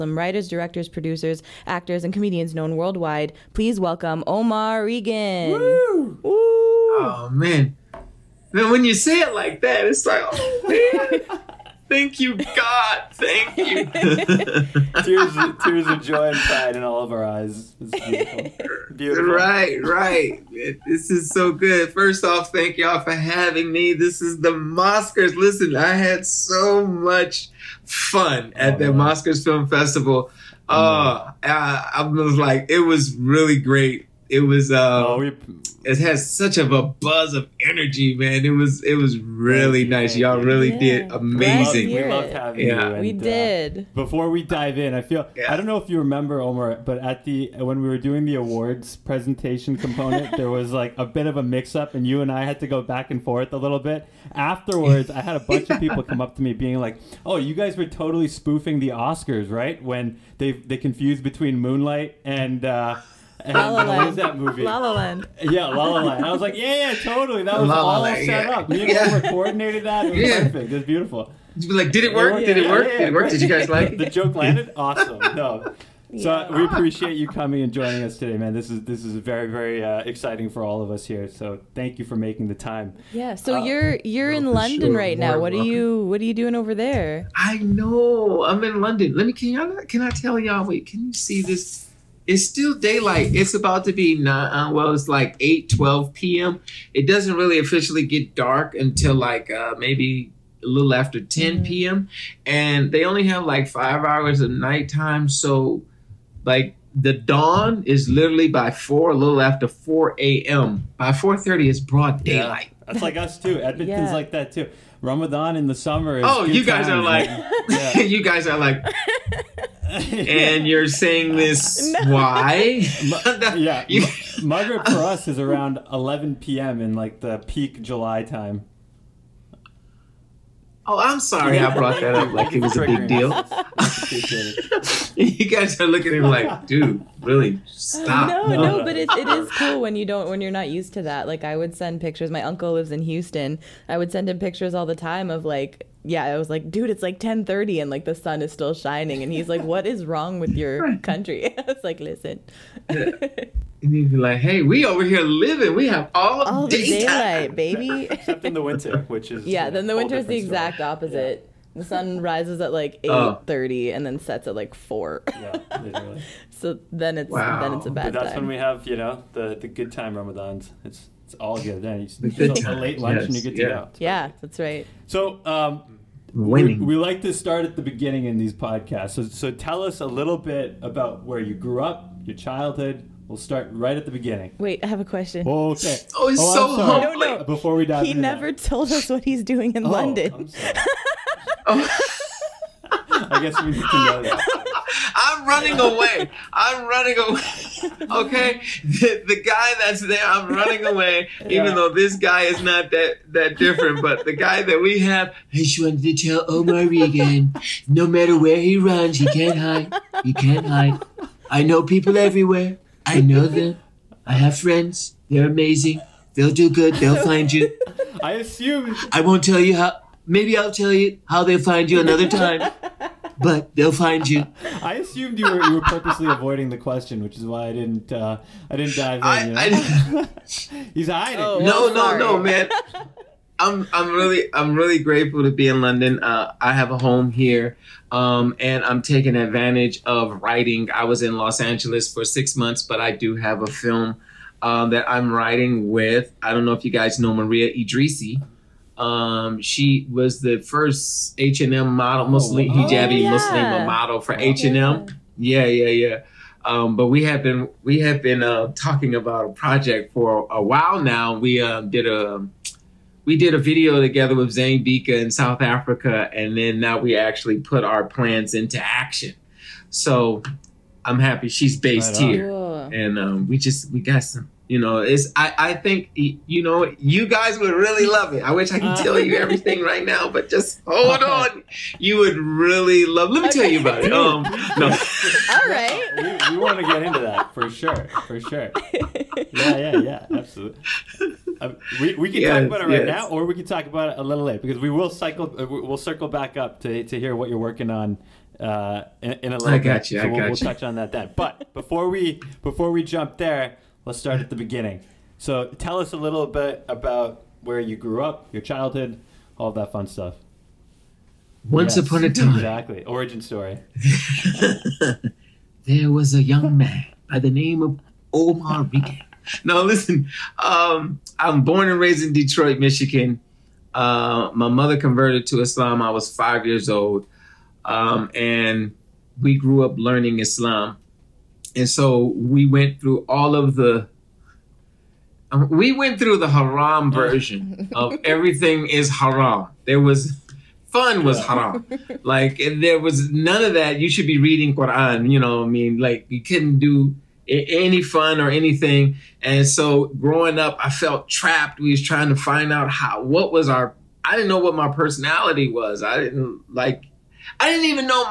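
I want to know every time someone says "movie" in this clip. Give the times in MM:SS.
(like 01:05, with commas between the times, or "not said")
01:04.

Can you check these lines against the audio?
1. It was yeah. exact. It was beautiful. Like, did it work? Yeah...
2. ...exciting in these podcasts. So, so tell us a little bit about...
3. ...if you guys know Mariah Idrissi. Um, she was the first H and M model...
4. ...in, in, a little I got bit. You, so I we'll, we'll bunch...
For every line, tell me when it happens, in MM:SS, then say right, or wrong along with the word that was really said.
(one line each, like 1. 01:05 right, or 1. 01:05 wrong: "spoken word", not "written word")
1. 01:10 wrong: "perfect", not "exact"
2. 02:57 wrong: "beginning", not "exciting"
3. 04:06 right
4. 04:59 wrong: "touch", not "bunch".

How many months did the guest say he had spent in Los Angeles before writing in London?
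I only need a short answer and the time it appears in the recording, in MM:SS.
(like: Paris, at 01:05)
6, at 04:02.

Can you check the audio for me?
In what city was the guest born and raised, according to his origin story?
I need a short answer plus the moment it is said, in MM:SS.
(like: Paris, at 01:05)
Detroit, at 05:22.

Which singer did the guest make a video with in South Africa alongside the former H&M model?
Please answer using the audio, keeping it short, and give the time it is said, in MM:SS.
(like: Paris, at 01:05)
Zain Bhikha, at 04:24.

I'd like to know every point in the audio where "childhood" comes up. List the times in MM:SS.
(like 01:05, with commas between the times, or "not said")
03:02, 05:08.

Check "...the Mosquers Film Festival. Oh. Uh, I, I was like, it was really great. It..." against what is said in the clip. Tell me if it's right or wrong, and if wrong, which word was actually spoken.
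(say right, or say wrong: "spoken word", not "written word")
right.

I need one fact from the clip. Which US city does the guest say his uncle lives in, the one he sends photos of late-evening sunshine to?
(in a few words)
Houston.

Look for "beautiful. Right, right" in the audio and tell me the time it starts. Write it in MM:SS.
00:18.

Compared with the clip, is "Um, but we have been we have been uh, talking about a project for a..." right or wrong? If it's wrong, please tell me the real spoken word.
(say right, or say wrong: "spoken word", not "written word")
right.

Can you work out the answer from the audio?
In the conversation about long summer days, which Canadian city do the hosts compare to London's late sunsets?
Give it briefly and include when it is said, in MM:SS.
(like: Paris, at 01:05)
Edmonton, at 01:53.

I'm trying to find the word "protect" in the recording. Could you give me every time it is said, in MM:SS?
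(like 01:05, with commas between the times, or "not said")
not said.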